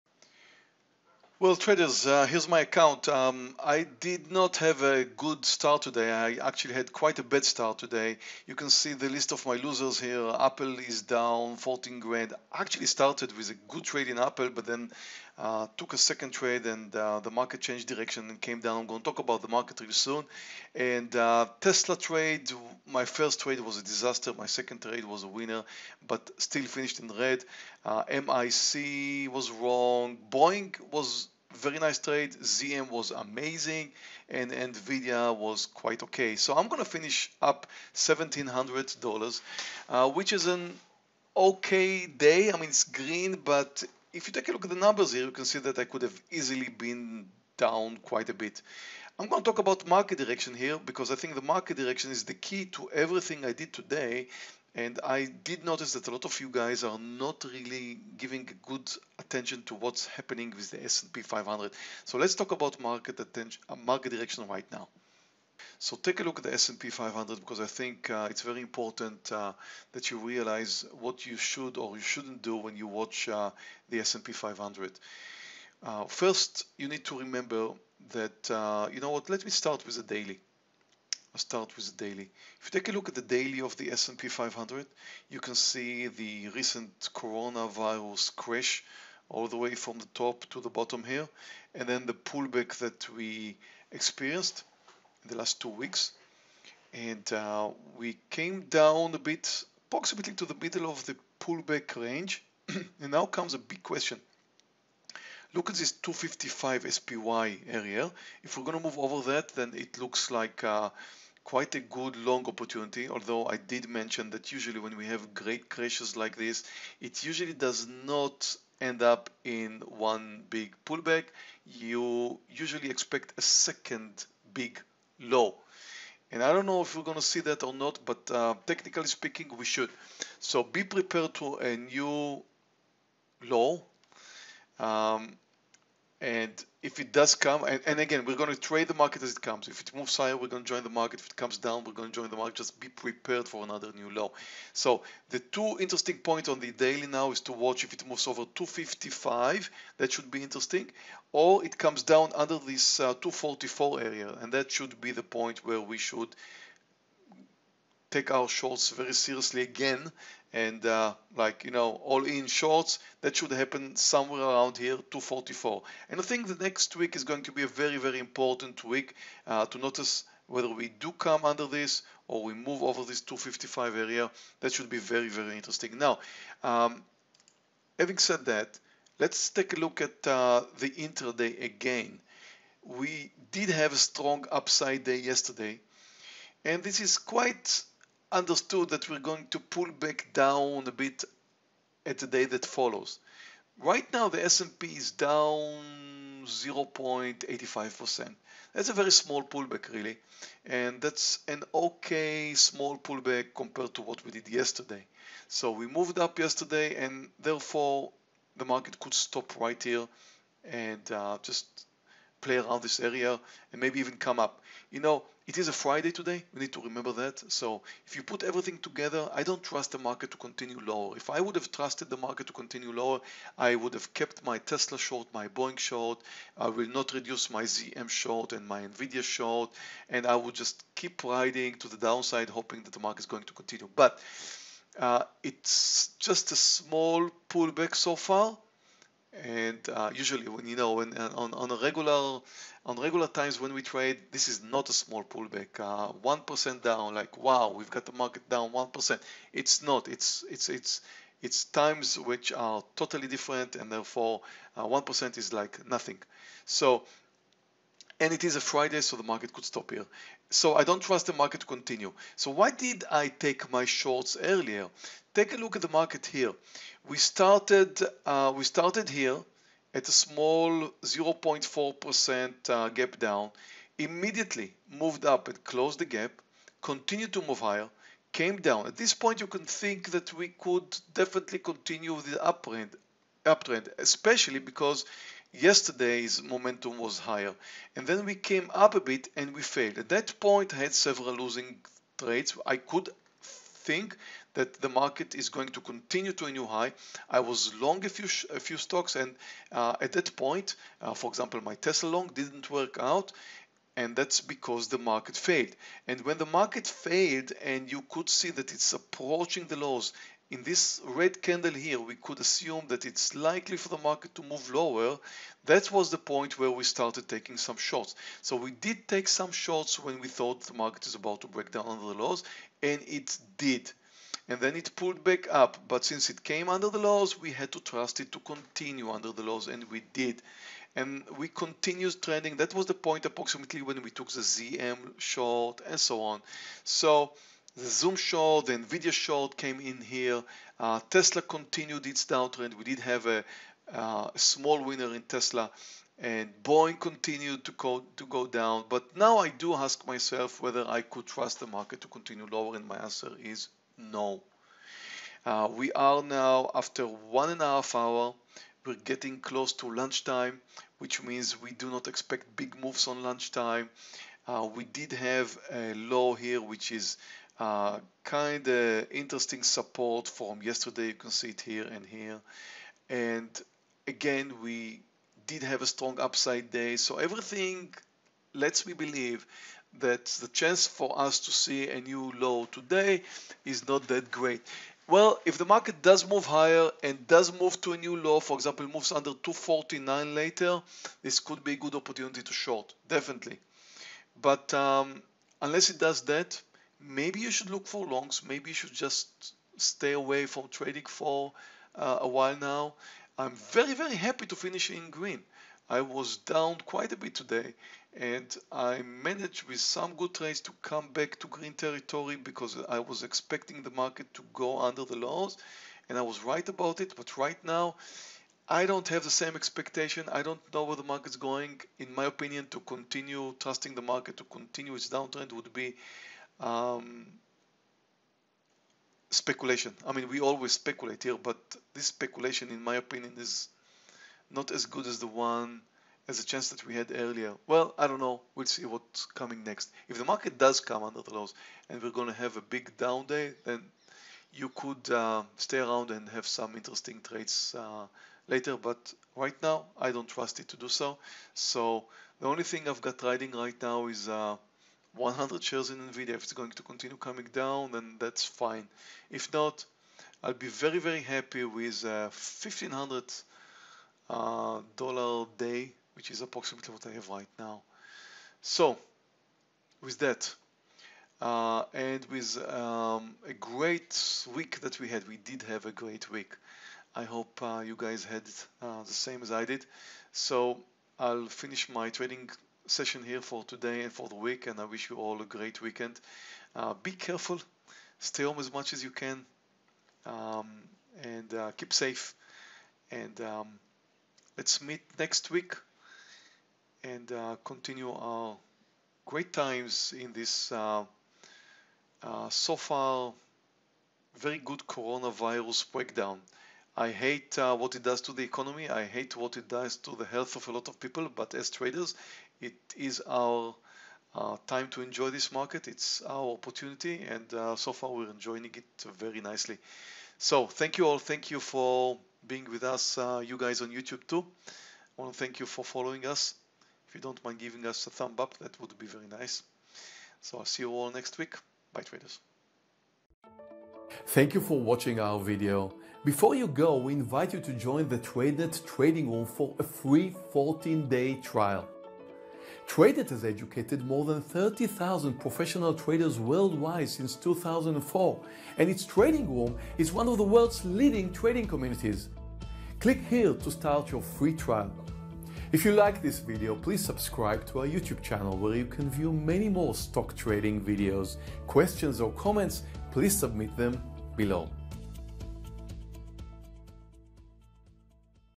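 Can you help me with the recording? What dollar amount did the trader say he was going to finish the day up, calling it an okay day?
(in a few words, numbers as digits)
$1,700.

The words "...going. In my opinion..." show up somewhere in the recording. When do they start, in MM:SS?
07:01.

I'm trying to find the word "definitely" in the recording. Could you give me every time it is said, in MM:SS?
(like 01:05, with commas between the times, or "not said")
04:41, 06:33.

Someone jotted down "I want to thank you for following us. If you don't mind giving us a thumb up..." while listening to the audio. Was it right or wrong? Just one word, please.
right.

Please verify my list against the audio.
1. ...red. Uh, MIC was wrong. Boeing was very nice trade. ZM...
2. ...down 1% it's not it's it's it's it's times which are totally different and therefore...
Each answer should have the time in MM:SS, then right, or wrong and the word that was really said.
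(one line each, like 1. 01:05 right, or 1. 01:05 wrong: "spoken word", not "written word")
1. 00:27 right
2. 04:08 right.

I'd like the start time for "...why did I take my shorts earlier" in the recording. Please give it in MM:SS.
04:22.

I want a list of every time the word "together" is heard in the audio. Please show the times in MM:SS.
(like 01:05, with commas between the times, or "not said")
03:38.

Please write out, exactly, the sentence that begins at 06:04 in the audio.
Uh, we did have a low here, which is uh, kind of interesting support from yesterday.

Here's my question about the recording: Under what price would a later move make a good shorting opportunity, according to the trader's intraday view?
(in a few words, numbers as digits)
249.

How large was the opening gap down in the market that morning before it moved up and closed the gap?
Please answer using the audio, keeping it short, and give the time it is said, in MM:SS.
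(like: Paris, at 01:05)
0.4%, at 04:31.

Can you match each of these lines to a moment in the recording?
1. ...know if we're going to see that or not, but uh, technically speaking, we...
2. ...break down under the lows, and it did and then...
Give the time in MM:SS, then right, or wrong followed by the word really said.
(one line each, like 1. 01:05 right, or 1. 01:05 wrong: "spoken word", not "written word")
1. 02:06 right
2. 05:21 right.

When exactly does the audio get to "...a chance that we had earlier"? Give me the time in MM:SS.
07:16.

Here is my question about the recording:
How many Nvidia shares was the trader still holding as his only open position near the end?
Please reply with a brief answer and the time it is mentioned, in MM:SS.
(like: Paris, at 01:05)
100, at 07:35.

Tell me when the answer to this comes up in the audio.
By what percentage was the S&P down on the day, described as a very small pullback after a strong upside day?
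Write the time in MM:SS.
03:16.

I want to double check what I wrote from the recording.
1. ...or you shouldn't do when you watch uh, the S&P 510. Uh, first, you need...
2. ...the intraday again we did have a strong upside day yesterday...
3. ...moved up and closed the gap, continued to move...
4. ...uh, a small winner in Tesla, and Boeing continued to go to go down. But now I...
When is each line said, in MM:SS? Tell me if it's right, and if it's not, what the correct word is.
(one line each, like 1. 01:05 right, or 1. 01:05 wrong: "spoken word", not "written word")
1. 01:11 wrong: "500", not "510"
2. 03:00 right
3. 04:34 right
4. 05:43 right.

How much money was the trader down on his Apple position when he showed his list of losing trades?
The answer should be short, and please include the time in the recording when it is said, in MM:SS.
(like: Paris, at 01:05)
14 grand, at 00:11.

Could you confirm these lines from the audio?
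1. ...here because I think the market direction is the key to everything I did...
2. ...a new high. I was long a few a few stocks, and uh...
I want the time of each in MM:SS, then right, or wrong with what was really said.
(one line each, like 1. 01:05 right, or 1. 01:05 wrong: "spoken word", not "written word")
1. 00:50 right
2. 04:56 right.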